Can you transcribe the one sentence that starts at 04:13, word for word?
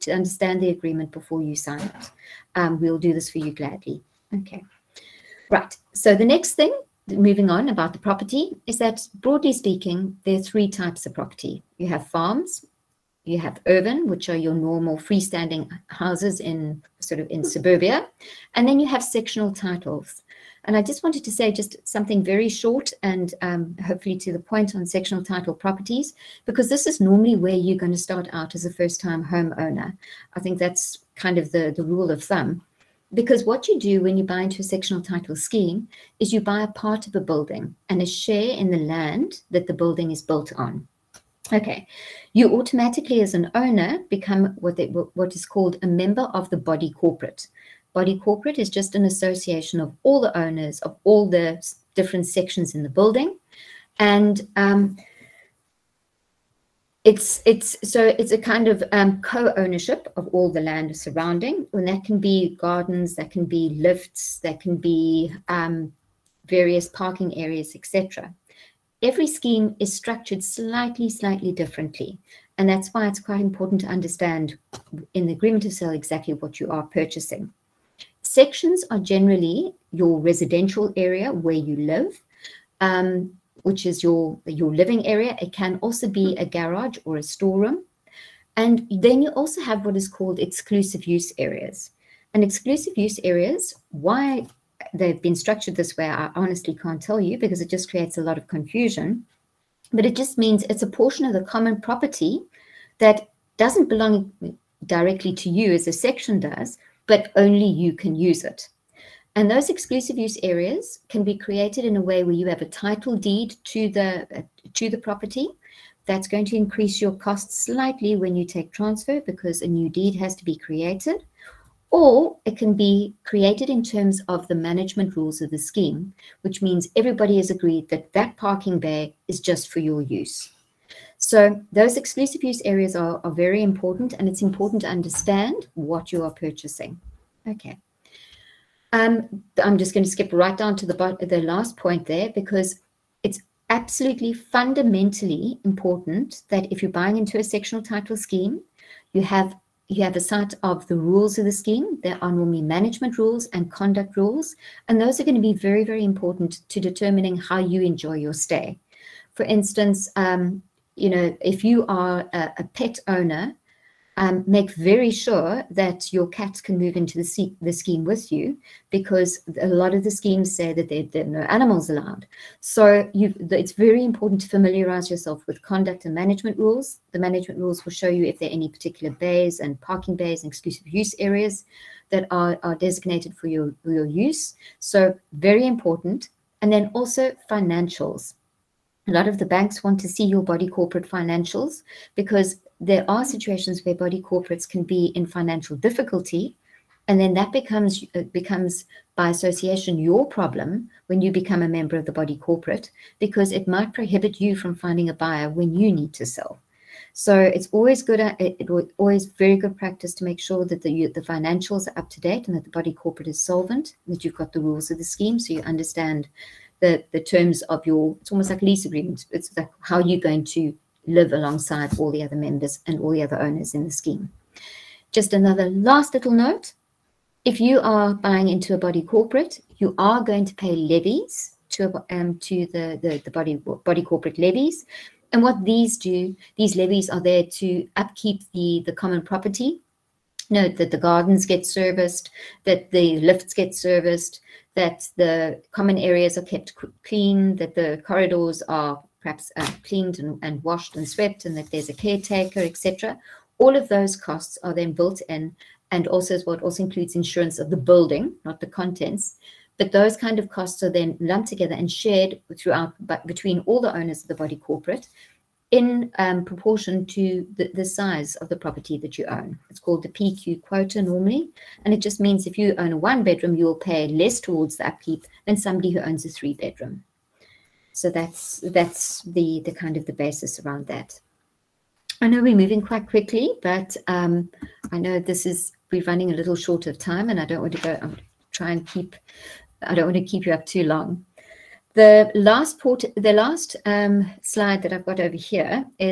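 All of those costs are then built in, and also is what also includes insurance of the building, not the contents.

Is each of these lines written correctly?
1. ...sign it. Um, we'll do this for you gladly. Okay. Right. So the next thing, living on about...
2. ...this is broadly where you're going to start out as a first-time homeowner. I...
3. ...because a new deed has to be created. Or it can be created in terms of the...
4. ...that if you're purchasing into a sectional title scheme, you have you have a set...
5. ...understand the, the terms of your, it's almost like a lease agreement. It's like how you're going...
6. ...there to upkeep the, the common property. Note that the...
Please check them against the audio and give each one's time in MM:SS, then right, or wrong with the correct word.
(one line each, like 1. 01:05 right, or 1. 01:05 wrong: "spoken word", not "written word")
1. 00:01 wrong: "moving", not "living"
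2. 00:26 wrong: "normally", not "broadly"
3. 01:59 right
4. 02:26 wrong: "buying", not "purchasing"
5. 03:35 right
6. 03:57 right.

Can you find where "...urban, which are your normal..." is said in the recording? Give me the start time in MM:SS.
00:13.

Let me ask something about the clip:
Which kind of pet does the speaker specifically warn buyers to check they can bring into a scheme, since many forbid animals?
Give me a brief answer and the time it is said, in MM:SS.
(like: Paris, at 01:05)
Cats, at 02:46.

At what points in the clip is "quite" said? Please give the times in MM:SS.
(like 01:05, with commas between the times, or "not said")
01:13, 04:42.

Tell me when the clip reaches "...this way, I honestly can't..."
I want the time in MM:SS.
01:35.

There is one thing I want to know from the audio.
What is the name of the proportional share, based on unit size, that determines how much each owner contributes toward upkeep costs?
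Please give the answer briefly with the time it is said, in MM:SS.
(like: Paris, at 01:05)
PQ quota, at 04:30.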